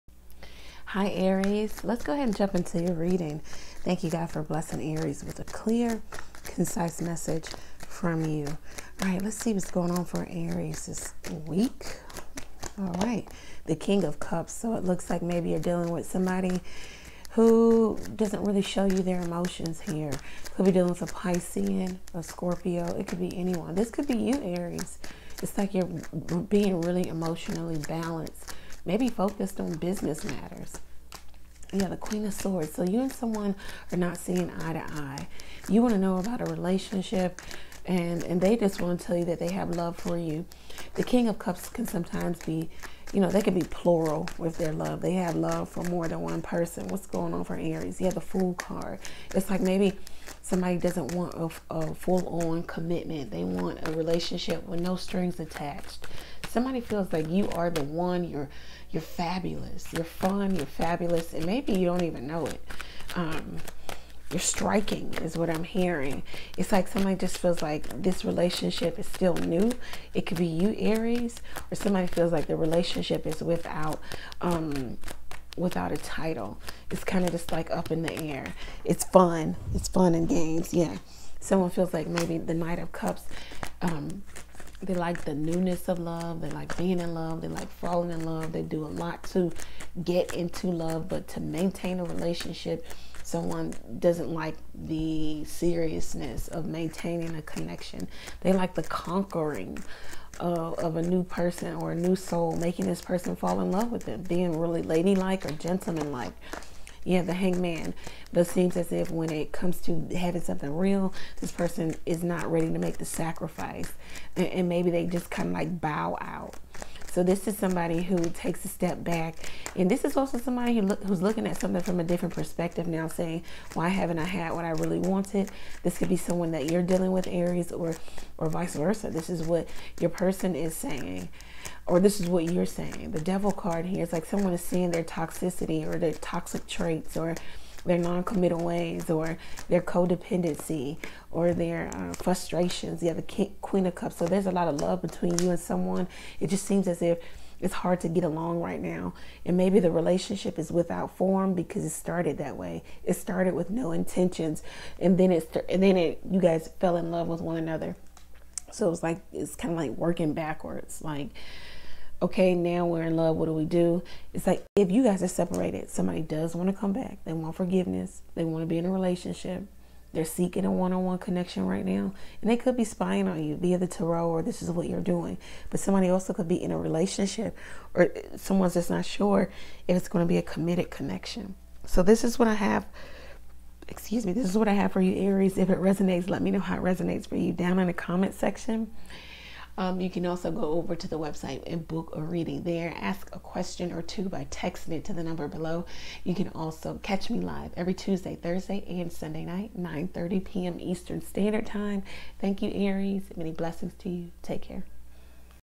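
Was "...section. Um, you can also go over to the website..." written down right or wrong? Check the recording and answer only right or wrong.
right.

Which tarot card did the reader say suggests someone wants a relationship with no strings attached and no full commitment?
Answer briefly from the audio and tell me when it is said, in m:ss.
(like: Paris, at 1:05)
The Fool, at 0:48.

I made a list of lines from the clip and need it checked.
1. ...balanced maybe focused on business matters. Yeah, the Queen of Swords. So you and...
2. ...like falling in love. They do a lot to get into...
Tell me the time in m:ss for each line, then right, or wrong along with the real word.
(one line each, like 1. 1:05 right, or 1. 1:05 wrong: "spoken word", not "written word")
1. 0:27 right
2. 1:27 right.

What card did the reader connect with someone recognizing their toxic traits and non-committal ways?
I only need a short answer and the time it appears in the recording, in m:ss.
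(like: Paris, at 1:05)
The Devil, at 2:13.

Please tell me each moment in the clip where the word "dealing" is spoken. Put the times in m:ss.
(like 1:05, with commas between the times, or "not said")
0:15, 0:20, 2:06.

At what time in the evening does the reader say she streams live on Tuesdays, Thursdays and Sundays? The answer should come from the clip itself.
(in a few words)
9:30 p.m. Eastern.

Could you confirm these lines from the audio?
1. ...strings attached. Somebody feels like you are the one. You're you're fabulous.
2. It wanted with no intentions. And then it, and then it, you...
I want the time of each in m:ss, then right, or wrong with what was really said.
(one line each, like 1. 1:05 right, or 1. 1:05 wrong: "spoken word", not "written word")
1. 0:54 right
2. 2:33 wrong: "started", not "wanted".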